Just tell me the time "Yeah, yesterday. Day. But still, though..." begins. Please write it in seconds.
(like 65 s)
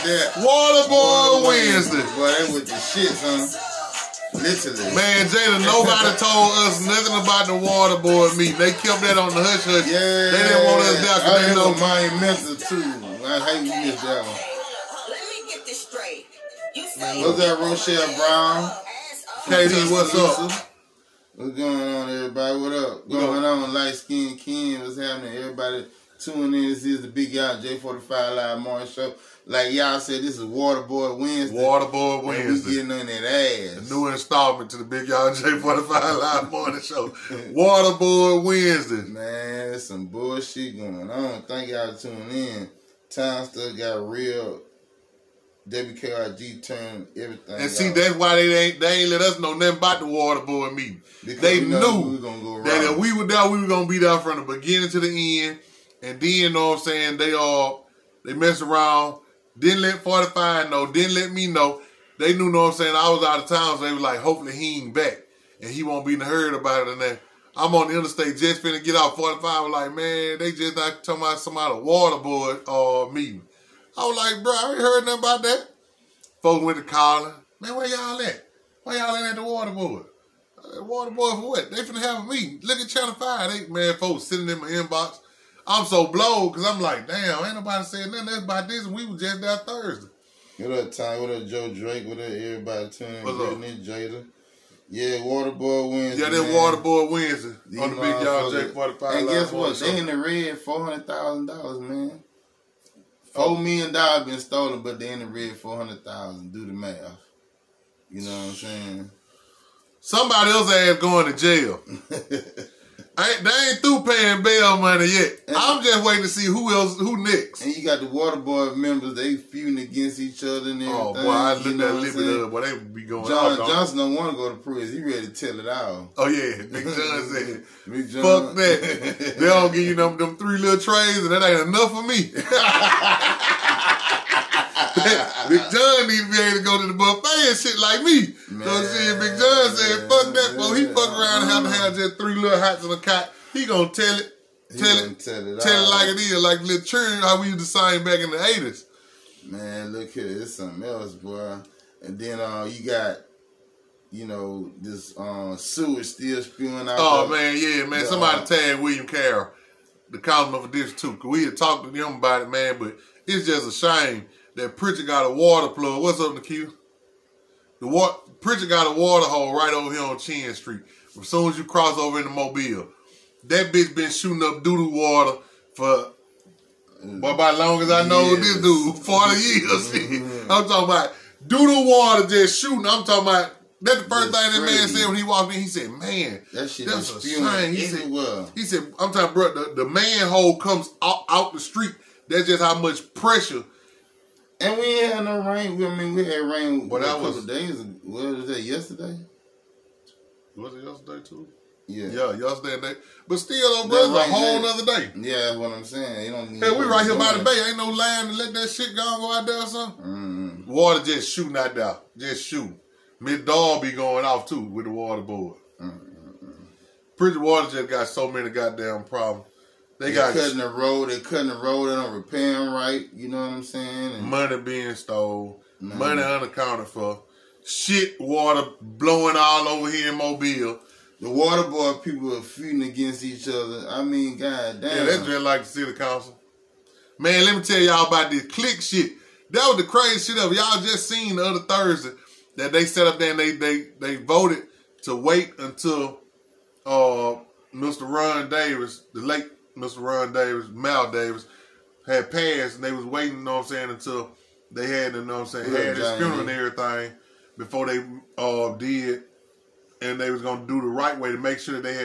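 202 s.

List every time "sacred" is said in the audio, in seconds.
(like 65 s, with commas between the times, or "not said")
not said.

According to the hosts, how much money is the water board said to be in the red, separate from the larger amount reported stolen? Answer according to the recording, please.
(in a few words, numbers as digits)
$400,000.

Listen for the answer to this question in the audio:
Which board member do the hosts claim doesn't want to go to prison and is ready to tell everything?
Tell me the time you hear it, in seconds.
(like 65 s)
123 s.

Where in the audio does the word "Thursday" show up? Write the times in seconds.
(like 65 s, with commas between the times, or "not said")
89 s, 241 s.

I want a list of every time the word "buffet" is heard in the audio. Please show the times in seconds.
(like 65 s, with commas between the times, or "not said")
136 s.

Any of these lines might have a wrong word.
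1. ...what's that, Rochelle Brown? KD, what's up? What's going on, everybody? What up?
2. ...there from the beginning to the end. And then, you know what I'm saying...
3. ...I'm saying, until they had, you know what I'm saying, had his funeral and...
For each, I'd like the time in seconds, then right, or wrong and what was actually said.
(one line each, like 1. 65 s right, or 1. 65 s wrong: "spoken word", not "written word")
1. 17 s right
2. 53 s right
3. 253 s right.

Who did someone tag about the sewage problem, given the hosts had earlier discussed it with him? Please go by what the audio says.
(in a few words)
William Carroll.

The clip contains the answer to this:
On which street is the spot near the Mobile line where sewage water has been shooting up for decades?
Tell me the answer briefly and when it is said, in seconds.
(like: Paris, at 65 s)
Chin Street, at 170 s.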